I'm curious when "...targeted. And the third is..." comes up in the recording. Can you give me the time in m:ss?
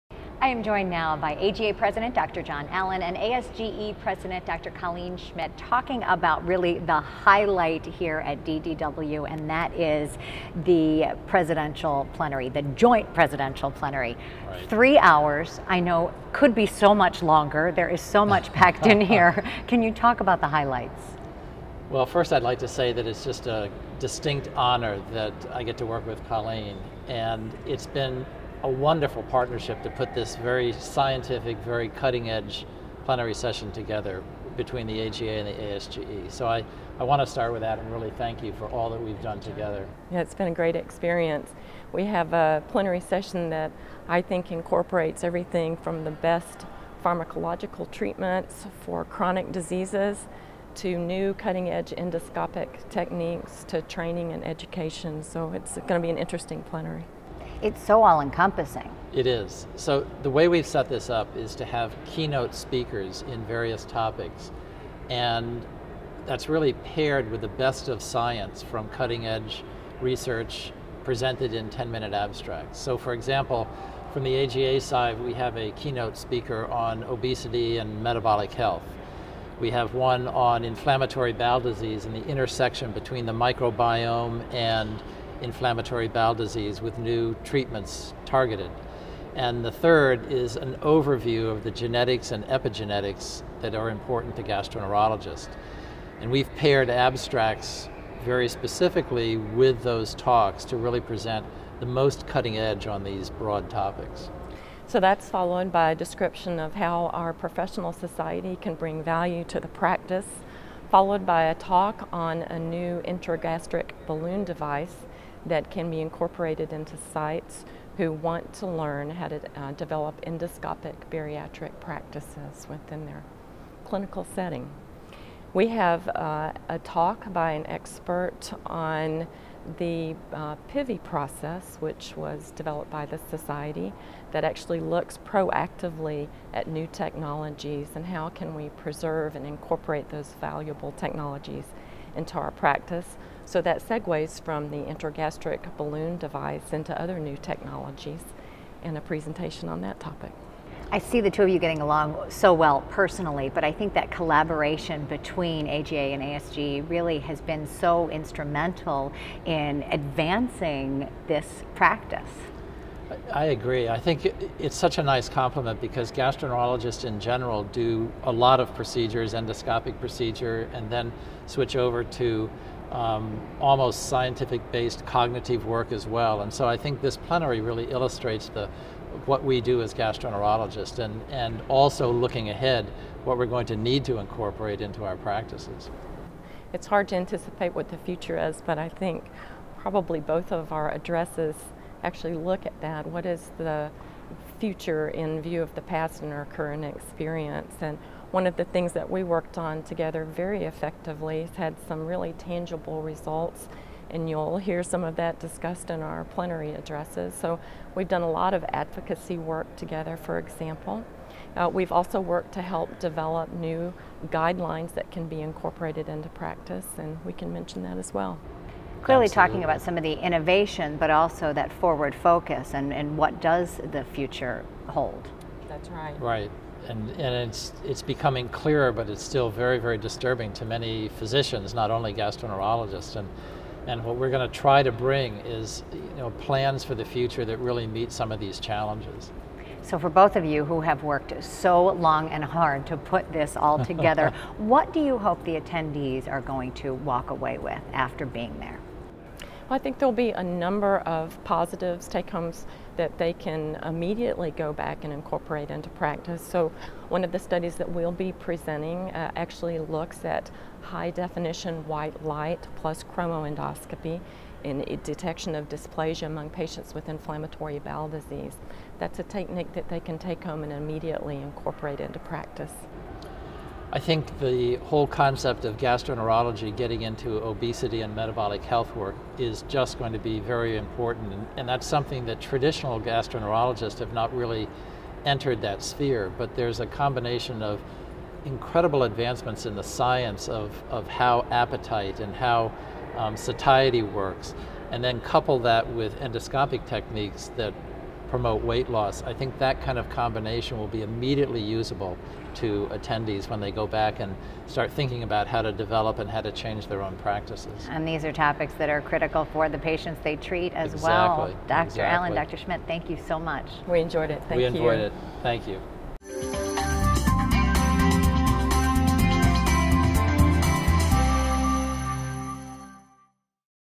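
1:28.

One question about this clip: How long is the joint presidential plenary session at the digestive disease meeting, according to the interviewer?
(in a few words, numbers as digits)
3 hours.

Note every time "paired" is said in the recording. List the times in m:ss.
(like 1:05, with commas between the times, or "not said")
1:06, 1:36.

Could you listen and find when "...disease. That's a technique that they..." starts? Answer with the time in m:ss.
4:28.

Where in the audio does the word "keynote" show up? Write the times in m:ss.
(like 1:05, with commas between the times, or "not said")
1:02, 1:15.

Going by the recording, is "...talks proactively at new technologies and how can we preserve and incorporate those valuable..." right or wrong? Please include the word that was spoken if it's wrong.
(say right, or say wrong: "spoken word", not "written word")
wrong: "looks", not "talks".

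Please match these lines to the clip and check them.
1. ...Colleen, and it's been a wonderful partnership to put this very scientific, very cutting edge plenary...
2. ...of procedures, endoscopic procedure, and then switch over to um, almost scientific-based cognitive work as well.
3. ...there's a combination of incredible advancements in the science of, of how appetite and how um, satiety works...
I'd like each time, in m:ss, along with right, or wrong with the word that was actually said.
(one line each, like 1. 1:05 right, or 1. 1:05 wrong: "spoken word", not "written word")
1. 0:26 right
2. 2:48 right
3. 4:46 right.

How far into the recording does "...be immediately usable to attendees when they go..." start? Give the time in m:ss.
5:00.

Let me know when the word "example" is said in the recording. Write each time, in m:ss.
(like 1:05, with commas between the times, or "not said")
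1:13, 3:30.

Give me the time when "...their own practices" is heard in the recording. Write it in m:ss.
5:06.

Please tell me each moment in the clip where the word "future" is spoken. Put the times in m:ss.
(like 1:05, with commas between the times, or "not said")
3:07, 3:14, 3:44, 3:57.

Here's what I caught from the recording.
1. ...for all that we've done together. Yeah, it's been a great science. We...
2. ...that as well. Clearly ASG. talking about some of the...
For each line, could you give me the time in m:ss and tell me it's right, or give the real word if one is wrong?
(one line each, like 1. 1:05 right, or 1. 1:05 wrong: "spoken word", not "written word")
1. 0:38 wrong: "experience", not "science"
2. 3:37 wrong: "Absolutely", not "ASG".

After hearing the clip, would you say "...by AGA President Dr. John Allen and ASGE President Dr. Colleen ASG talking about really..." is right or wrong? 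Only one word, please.
wrong.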